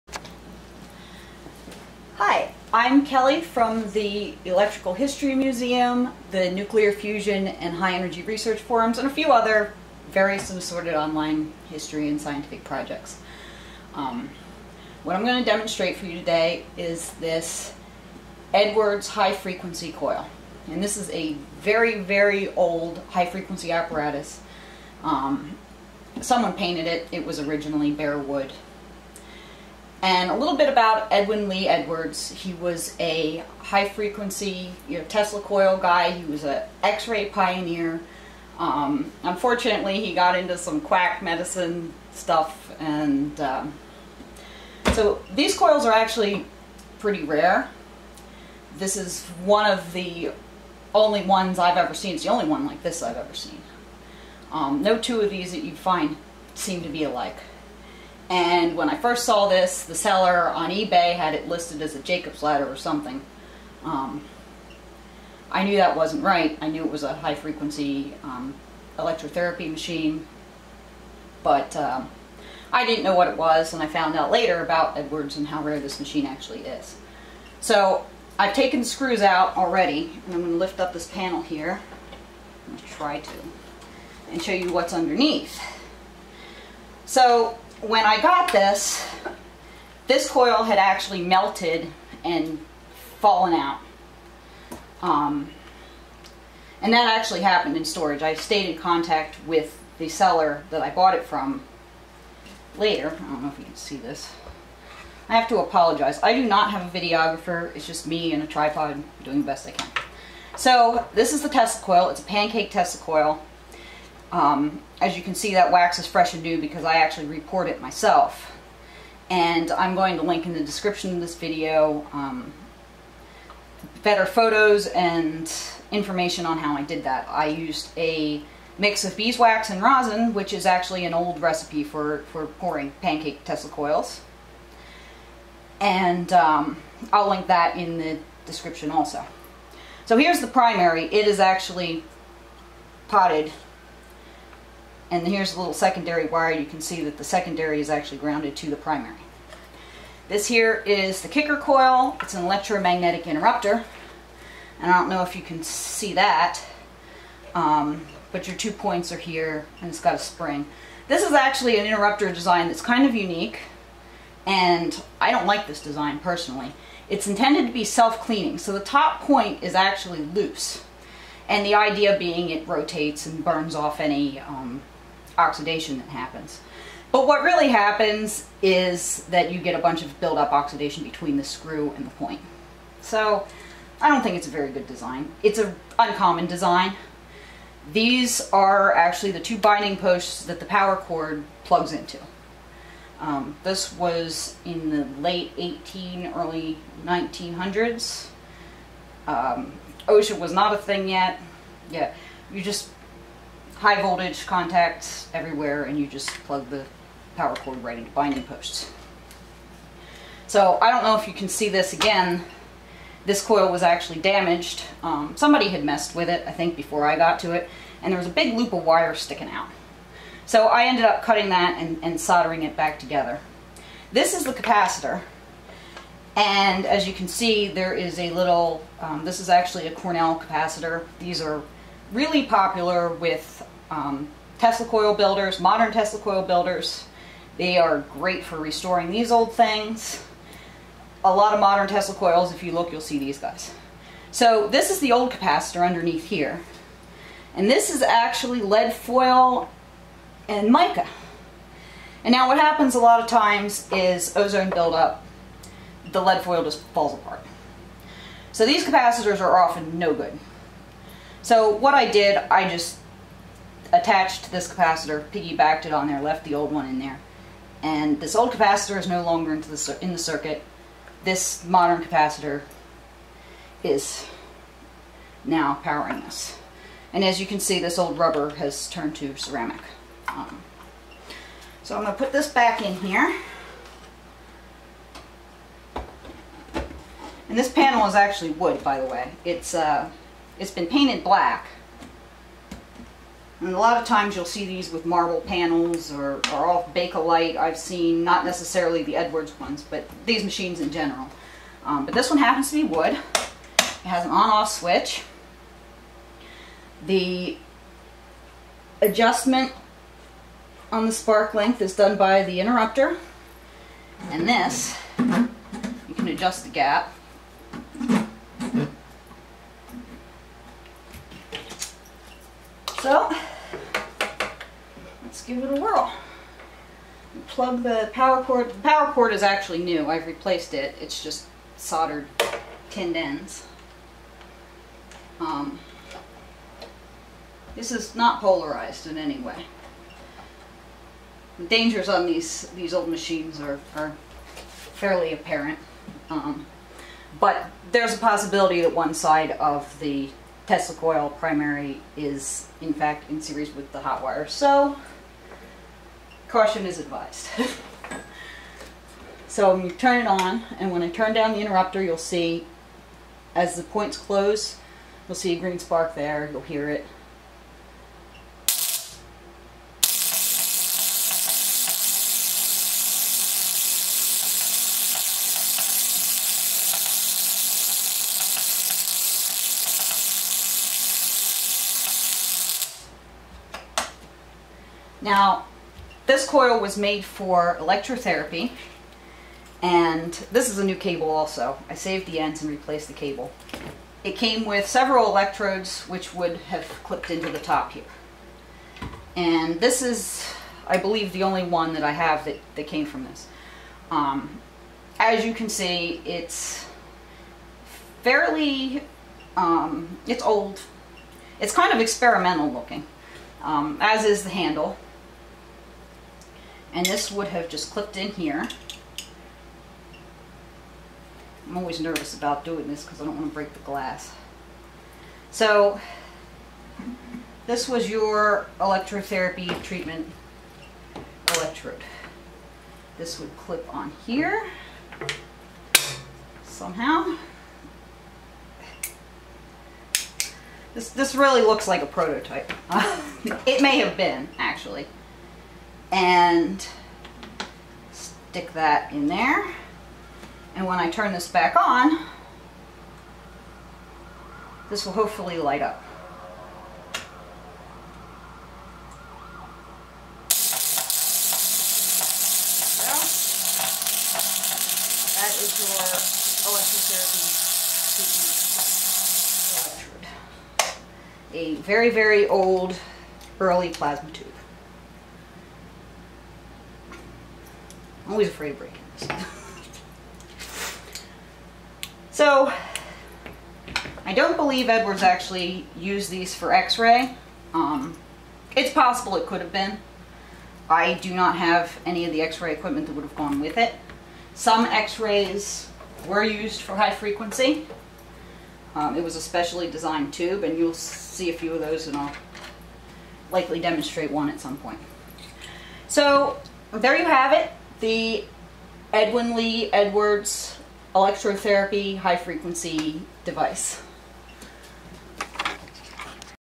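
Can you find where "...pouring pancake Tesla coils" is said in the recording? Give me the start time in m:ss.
2:12.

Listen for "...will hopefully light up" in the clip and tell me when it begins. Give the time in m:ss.
7:35.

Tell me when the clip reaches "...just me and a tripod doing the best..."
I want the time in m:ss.
1:47.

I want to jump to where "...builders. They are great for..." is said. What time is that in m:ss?
3:56.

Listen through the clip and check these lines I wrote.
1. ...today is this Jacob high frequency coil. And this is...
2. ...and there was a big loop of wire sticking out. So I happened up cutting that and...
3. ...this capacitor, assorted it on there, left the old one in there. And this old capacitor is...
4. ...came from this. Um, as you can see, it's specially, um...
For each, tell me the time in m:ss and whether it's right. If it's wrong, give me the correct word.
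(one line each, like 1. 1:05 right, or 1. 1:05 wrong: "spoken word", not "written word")
1. 0:16 wrong: "Edwards", not "Jacob"
2. 3:38 wrong: "ended", not "happened"
3. 4:24 wrong: "piggybacked", not "assorted"
4. 6:42 wrong: "fairly", not "specially".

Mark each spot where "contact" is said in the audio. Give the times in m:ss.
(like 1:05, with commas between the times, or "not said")
1:38, 3:24.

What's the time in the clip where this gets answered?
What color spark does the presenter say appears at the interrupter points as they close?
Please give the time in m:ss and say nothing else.
6:05.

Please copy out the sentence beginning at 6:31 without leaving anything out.
I saved the ends and replaced the cable.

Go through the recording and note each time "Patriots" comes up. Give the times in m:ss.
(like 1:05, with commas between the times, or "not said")
not said.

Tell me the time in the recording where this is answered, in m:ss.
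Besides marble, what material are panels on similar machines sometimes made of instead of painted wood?
4:56.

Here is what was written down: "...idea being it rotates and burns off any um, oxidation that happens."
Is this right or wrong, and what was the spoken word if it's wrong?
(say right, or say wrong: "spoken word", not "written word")
right.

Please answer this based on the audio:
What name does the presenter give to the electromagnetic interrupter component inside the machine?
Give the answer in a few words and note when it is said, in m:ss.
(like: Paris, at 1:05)
kicker coil, at 2:31.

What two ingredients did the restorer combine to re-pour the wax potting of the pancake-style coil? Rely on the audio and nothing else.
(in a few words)
beeswax and rosin.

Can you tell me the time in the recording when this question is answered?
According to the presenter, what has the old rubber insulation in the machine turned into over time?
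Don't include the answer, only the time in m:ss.
4:39.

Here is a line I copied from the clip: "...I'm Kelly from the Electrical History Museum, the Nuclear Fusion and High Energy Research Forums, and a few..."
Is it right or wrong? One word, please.
right.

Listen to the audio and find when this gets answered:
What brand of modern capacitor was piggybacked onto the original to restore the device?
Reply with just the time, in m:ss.
3:49.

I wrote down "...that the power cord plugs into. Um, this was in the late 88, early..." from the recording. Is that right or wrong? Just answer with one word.
wrong.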